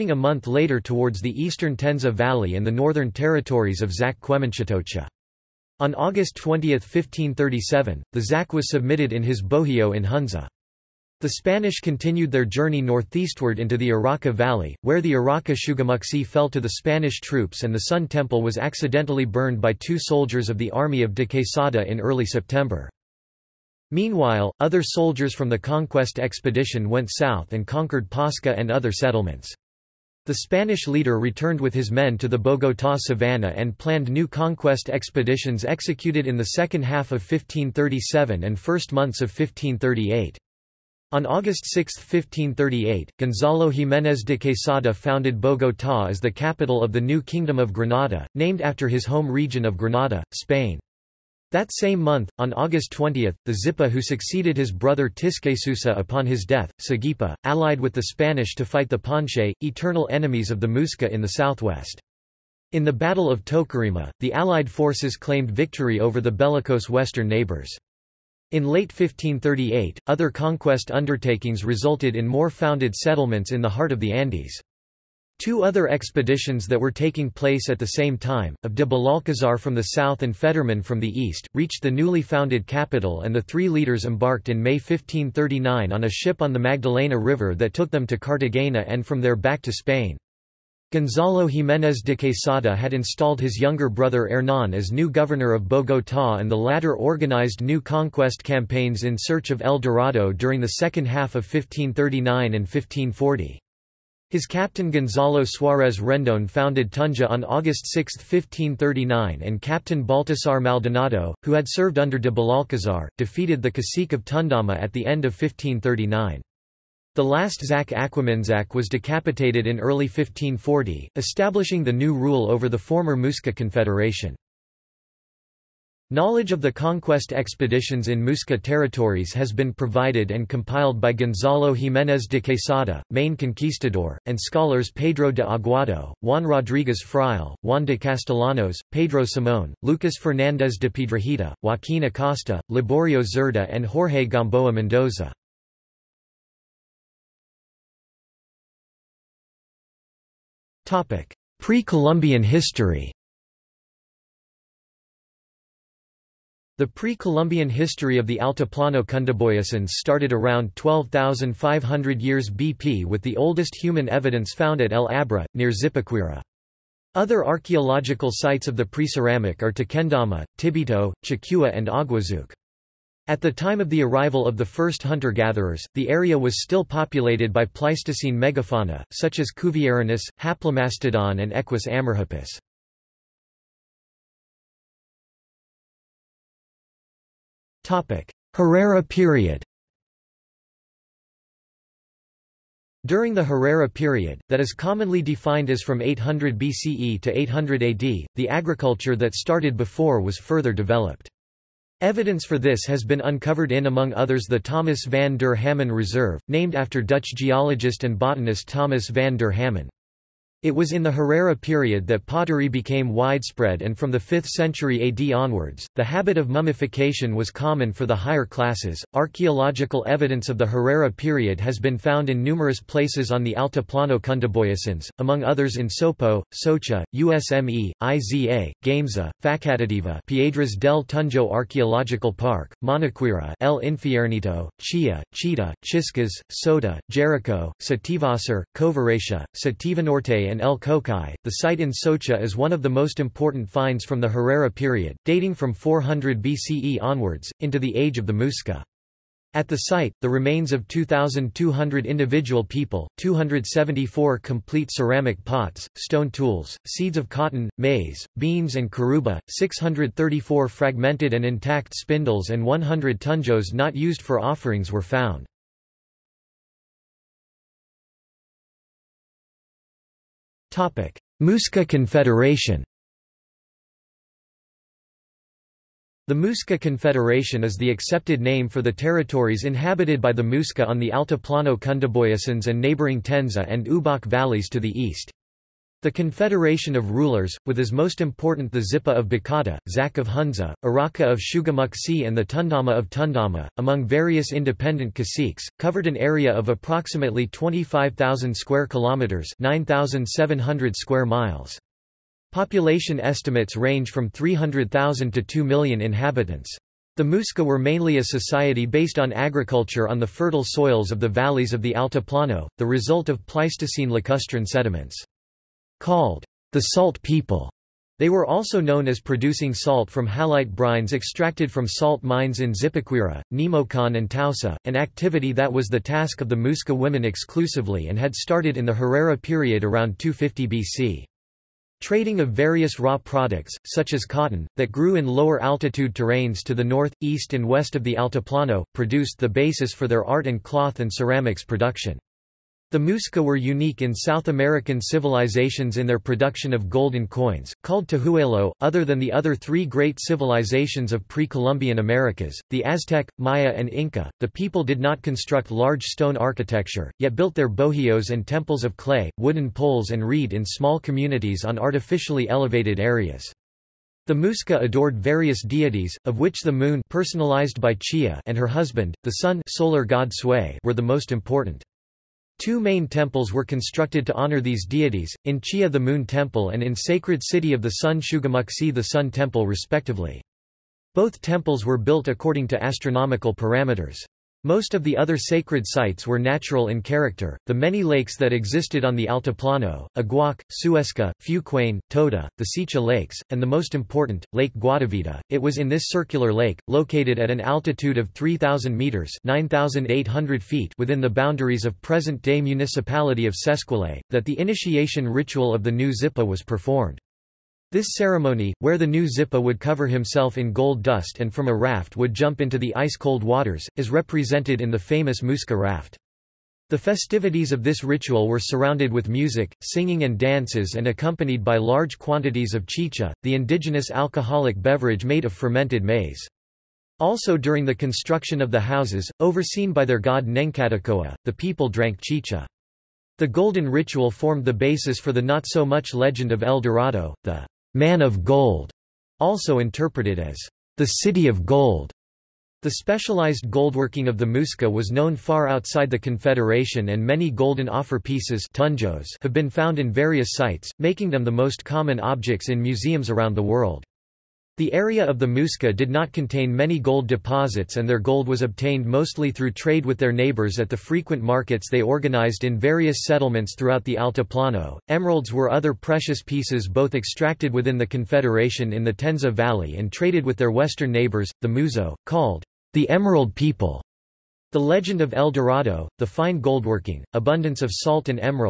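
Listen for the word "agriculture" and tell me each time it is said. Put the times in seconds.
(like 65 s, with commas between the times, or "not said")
198 s, 309 s.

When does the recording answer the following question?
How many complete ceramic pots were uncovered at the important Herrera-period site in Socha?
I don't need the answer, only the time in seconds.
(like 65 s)
253 s.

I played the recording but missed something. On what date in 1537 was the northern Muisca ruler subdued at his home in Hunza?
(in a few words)
August 20, 1537.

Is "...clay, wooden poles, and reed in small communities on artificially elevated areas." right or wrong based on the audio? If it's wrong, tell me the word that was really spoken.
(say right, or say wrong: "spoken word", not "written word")
right.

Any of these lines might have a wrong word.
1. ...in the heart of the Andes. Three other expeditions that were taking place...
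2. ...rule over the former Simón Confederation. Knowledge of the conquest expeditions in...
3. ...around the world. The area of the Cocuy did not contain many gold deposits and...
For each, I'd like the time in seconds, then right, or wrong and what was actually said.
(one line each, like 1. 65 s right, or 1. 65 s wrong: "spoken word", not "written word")
1. 73 s wrong: "Two", not "Three"
2. 122 s wrong: "Muisca", not "Simón"
3. 453 s wrong: "Muisca", not "Cocuy".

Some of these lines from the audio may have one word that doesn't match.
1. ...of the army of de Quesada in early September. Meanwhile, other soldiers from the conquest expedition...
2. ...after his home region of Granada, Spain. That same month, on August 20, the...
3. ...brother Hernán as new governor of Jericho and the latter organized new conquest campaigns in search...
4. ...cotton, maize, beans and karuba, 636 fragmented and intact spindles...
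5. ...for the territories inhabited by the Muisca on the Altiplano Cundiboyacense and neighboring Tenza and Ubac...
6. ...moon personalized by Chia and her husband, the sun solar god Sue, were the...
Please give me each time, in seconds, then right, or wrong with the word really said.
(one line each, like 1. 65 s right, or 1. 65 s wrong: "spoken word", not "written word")
1. 20 s right
2. 48 s right
3. 93 s wrong: "Bogotá", not "Jericho"
4. 257 s wrong: "634", not "636"
5. 278 s right
6. 366 s right.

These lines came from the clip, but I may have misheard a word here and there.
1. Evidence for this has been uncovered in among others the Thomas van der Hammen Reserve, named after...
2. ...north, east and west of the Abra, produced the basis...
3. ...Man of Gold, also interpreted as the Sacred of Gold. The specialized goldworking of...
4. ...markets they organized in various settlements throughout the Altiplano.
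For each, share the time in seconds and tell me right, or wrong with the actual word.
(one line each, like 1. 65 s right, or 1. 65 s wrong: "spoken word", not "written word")
1. 201 s right
2. 336 s wrong: "Altiplano", not "Abra"
3. 437 s wrong: "City", not "Sacred"
4. 461 s right.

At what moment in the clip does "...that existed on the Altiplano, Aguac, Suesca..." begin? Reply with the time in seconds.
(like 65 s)
388 s.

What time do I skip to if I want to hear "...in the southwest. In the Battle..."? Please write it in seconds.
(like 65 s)
61 s.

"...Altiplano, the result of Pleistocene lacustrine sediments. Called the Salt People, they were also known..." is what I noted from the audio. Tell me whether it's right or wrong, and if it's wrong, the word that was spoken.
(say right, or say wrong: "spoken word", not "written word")
right.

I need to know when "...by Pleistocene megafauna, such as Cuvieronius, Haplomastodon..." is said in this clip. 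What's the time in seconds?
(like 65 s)
177 s.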